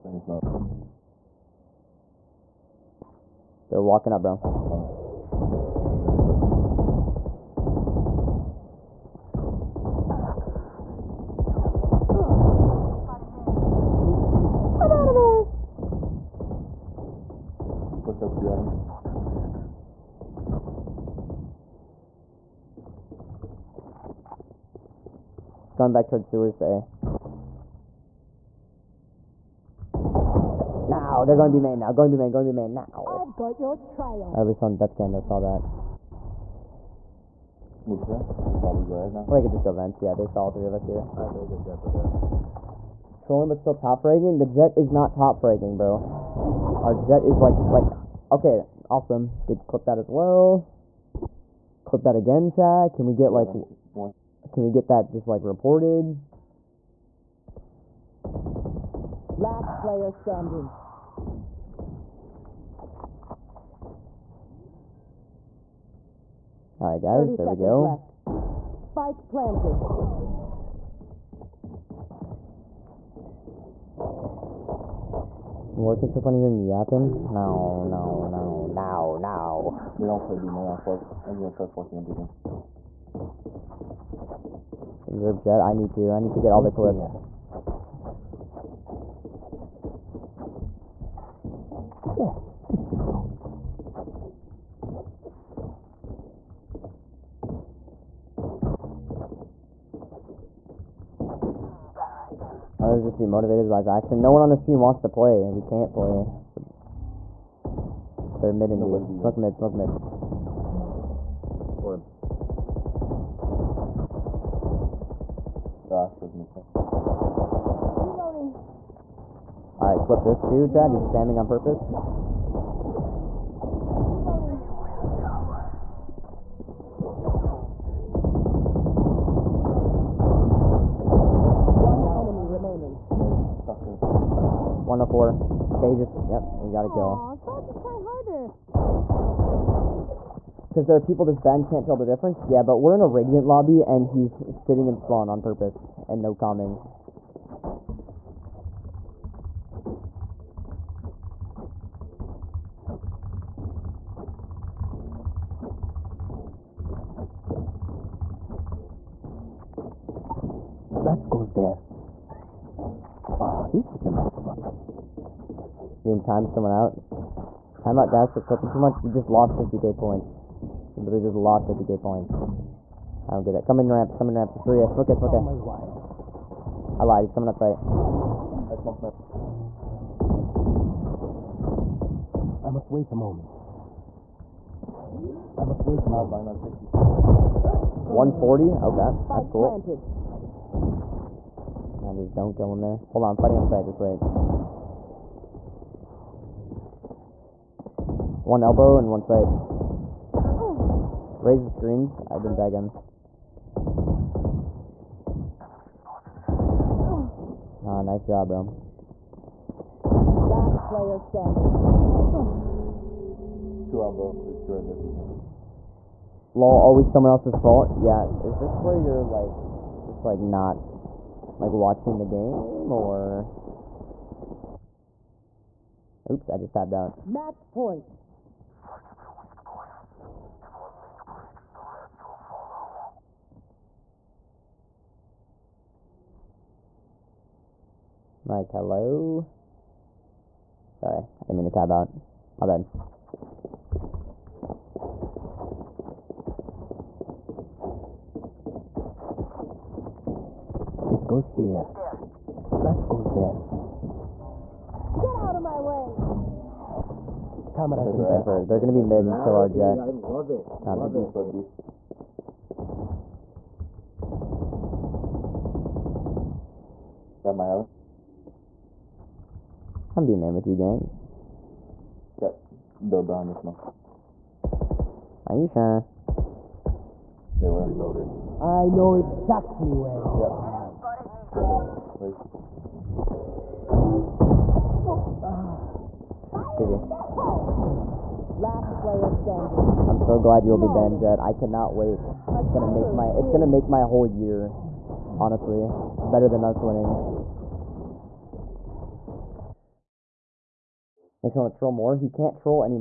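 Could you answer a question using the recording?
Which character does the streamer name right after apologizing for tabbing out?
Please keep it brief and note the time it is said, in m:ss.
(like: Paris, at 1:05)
Cypher, at 4:18.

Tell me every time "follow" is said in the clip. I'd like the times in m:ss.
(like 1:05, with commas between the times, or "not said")
3:52.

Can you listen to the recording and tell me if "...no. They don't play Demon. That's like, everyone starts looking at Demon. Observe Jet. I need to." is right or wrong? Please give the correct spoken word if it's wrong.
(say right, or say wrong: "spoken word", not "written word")
right.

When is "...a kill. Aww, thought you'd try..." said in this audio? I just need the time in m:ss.
2:16.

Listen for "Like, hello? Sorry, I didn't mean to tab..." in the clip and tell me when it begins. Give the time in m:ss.
3:58.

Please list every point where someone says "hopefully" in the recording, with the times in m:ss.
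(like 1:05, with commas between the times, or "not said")
not said.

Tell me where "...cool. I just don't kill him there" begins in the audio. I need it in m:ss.
3:09.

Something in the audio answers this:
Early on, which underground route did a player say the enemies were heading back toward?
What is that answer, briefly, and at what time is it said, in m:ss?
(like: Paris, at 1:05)
sewers, at 0:26.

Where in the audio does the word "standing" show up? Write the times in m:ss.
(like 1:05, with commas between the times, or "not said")
1:00, 3:31, 4:49.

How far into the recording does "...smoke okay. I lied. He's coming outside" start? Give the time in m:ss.
2:55.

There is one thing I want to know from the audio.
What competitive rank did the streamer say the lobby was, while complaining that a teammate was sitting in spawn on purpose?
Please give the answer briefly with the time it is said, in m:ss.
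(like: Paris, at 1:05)
Radiant, at 2:23.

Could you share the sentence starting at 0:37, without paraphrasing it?
We should probably go right now.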